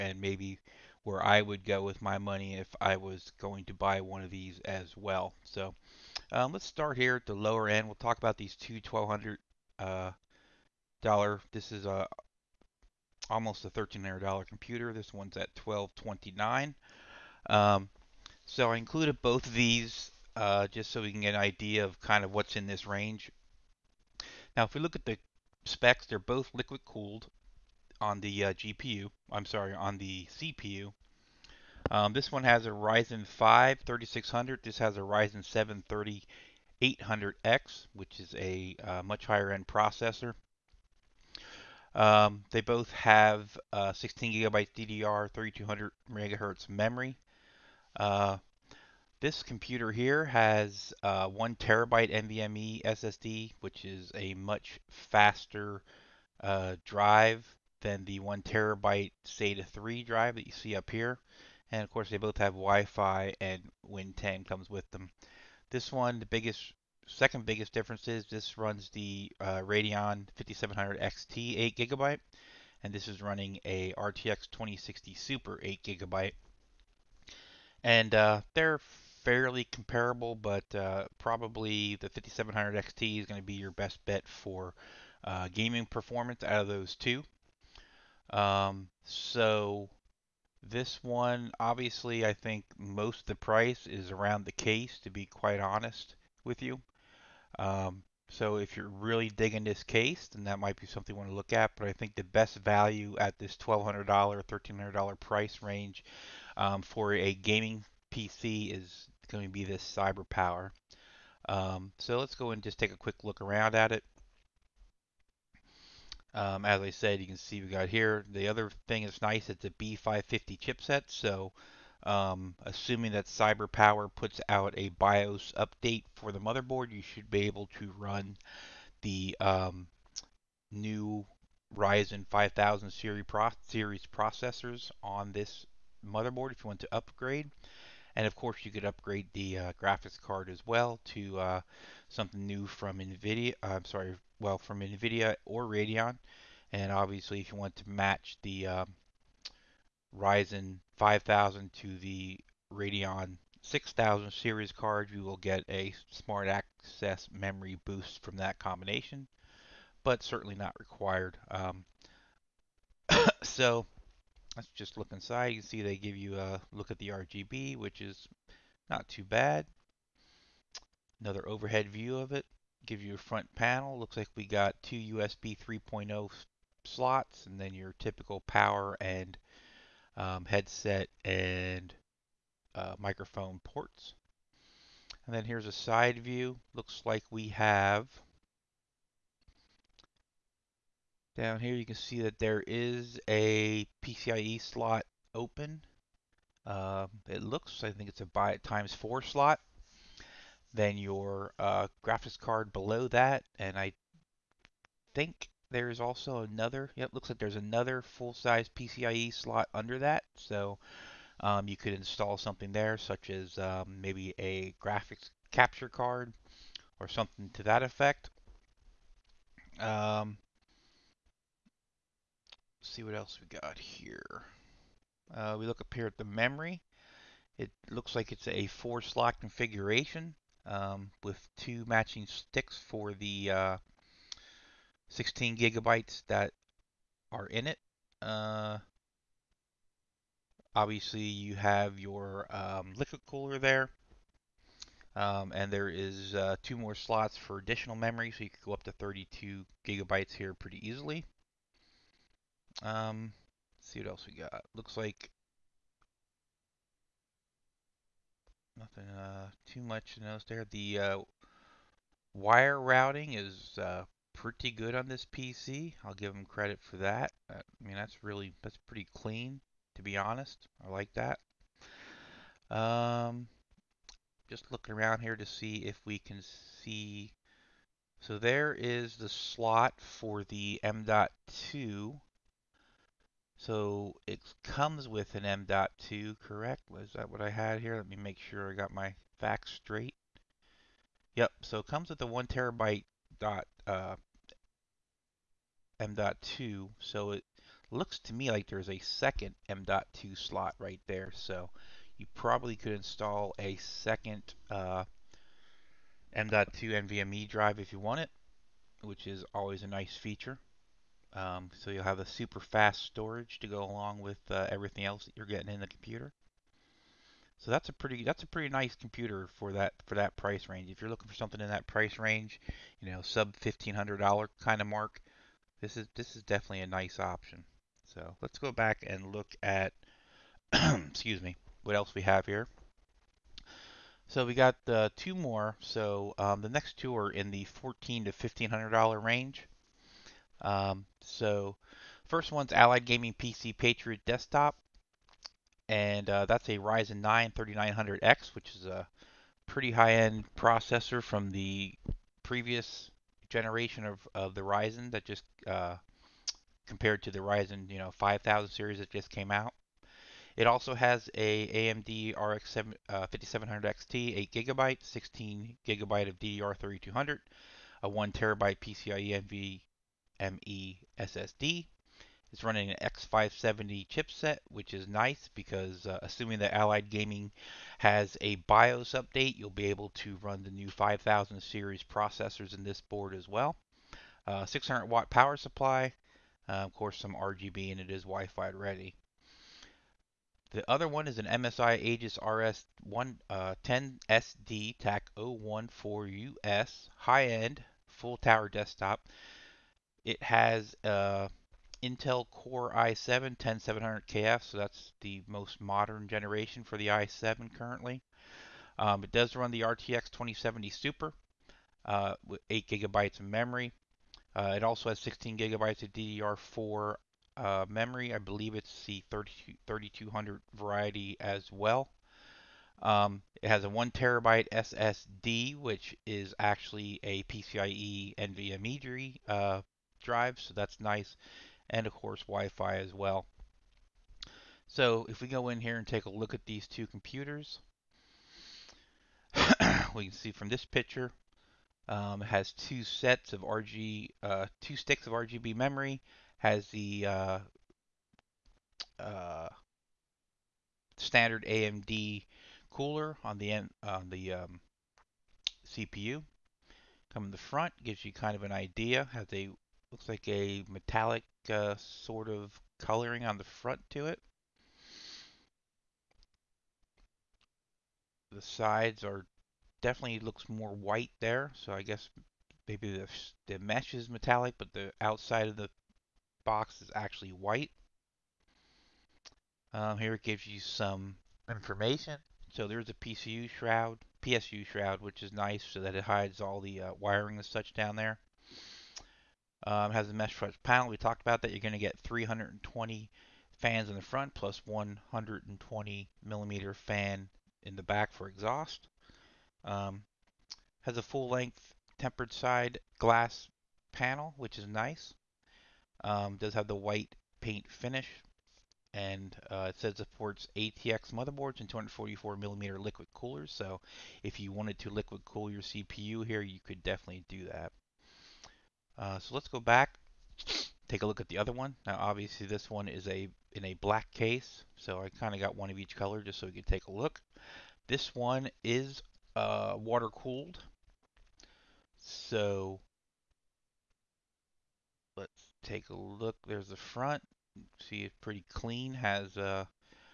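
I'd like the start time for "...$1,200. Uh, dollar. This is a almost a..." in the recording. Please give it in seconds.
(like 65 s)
8 s.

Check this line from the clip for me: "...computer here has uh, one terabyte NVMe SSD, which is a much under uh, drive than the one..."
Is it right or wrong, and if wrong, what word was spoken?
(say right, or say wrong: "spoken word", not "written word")
wrong: "faster", not "under".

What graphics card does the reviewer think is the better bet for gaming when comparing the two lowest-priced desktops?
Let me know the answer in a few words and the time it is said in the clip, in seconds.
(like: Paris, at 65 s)
Radeon 5700 XT, at 69 s.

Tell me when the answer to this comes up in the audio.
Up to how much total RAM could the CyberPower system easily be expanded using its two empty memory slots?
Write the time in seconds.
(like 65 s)
248 s.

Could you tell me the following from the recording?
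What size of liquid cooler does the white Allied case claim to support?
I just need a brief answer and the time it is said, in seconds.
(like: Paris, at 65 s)
244 mm, at 511 s.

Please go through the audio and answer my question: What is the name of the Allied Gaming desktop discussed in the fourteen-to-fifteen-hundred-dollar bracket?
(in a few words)
Patriot.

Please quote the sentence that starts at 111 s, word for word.
Um, so let's go and just take a quick look around at it.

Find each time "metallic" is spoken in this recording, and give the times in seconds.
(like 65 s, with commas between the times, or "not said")
460 s, 474 s.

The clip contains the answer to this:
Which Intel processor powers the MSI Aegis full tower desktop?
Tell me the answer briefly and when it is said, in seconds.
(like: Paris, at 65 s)
Core i7 10700KF, at 402 s.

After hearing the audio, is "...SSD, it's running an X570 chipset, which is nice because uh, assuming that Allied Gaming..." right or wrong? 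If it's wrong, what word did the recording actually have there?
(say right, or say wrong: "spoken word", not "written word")
right.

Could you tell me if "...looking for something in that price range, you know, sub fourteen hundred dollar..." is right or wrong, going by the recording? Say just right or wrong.
wrong.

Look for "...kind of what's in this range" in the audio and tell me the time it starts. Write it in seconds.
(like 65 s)
22 s.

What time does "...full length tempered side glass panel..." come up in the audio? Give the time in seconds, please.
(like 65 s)
501 s.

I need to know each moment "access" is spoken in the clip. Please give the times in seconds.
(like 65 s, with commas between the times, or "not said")
156 s.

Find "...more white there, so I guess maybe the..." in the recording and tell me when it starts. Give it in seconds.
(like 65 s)
470 s.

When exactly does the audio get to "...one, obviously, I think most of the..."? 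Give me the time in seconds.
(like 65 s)
91 s.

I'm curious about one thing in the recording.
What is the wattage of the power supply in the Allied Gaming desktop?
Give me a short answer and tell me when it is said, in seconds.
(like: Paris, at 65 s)
600 watt, at 384 s.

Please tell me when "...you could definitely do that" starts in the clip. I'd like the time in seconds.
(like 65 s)
516 s.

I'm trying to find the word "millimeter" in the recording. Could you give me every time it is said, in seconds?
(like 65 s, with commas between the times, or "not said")
496 s, 512 s.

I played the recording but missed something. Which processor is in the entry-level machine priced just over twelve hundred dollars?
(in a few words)
Ryzen 5 3600.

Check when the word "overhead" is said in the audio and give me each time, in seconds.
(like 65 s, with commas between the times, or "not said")
171 s.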